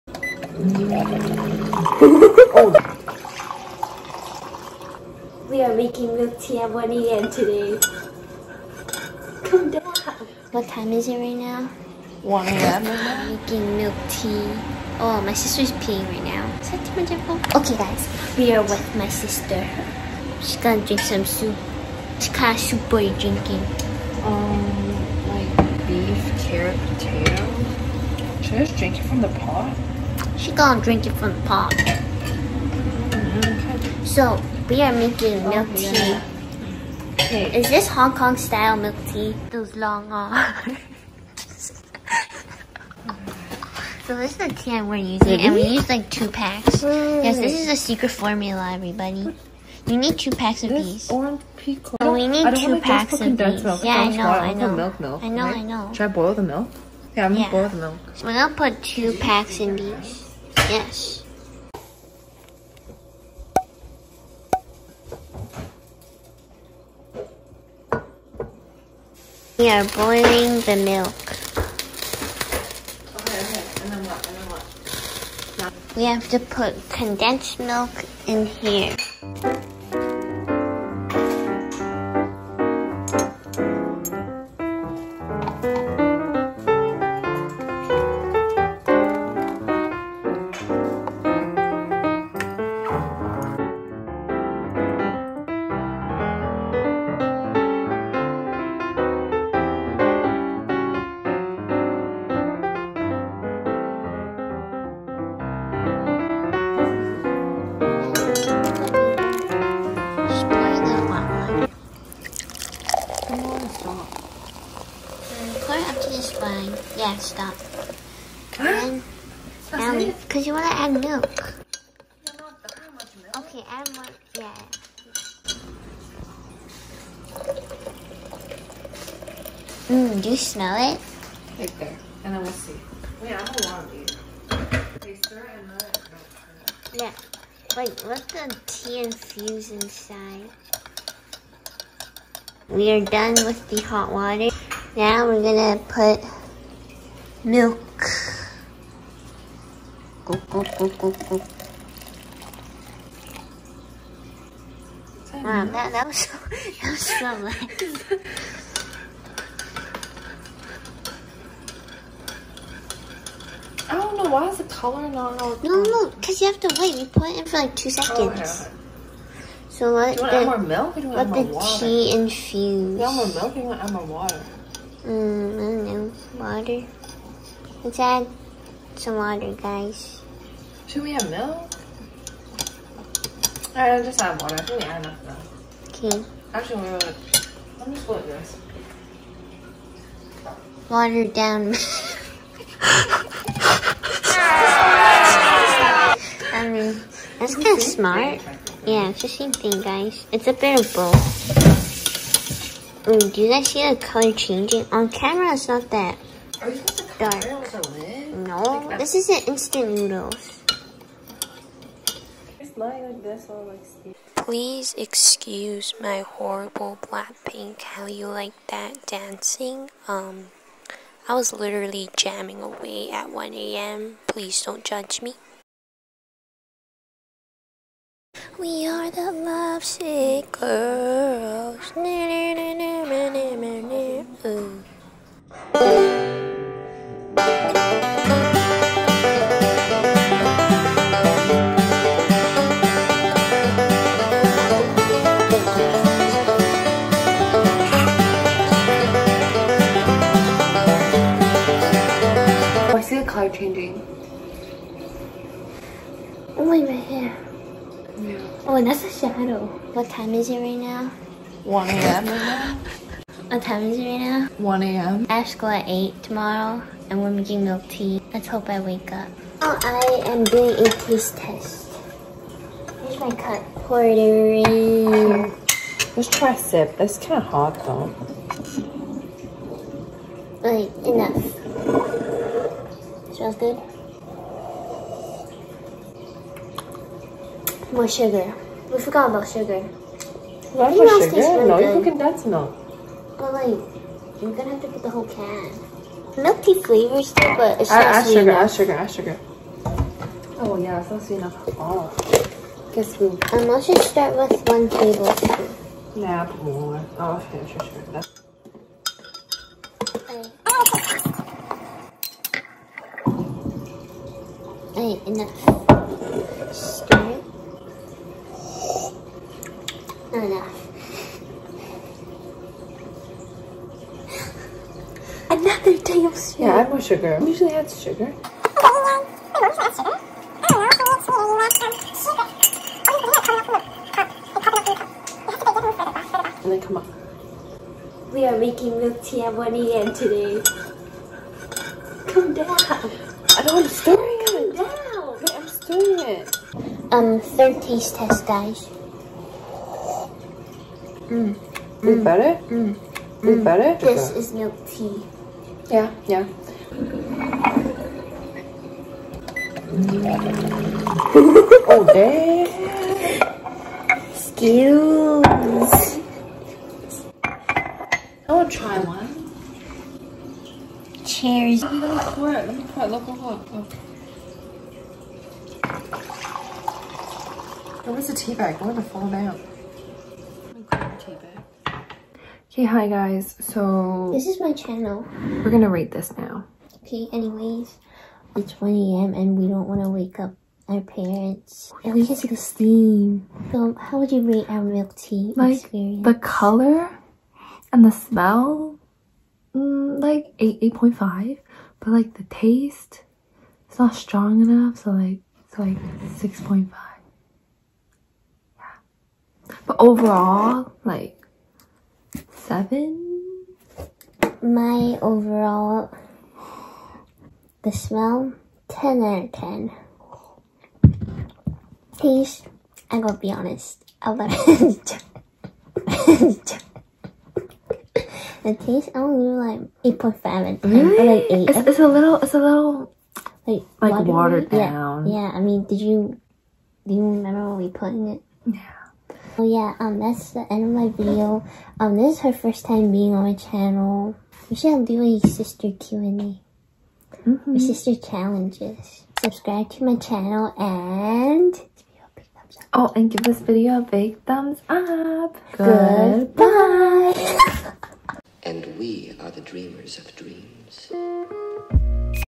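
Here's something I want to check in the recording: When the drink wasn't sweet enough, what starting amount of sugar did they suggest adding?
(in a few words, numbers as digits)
one tablespoon.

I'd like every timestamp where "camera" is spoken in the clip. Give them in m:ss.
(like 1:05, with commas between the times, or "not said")
3:25.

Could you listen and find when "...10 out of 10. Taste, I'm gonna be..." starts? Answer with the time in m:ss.
6:58.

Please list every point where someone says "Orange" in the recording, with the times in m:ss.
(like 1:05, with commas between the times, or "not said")
0:51.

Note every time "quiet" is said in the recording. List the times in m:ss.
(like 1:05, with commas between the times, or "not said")
not said.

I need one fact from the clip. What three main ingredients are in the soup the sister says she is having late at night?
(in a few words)
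beef, carrot, potato.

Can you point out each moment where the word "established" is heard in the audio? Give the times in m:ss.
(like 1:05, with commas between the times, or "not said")
not said.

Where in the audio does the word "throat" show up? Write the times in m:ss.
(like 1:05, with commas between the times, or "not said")
not said.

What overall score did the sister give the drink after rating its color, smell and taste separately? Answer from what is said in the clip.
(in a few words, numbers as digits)
7.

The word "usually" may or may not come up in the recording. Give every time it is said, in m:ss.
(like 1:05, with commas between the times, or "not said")
5:27.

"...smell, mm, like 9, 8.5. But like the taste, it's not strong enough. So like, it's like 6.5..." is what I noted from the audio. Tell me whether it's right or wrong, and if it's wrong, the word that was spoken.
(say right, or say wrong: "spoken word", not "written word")
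wrong: "8", not "9".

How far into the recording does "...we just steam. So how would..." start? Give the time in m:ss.
6:32.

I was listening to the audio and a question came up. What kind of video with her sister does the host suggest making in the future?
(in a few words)
sister Q&A.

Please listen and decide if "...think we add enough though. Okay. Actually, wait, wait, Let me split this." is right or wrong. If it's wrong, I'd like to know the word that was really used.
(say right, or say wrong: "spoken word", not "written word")
right.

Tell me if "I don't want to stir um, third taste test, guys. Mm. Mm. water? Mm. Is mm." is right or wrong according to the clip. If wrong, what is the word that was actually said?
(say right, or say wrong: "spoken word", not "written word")
wrong: "better", not "water".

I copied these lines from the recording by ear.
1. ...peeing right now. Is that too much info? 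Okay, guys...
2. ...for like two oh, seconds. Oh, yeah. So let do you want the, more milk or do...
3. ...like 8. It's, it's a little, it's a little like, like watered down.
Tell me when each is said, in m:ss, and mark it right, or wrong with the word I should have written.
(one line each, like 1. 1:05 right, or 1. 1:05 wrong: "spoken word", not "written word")
1. 0:15 right
2. 2:47 right
3. 7:11 right.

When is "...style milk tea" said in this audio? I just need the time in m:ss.
0:38.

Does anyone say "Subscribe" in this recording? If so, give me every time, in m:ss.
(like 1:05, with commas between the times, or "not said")
7:29.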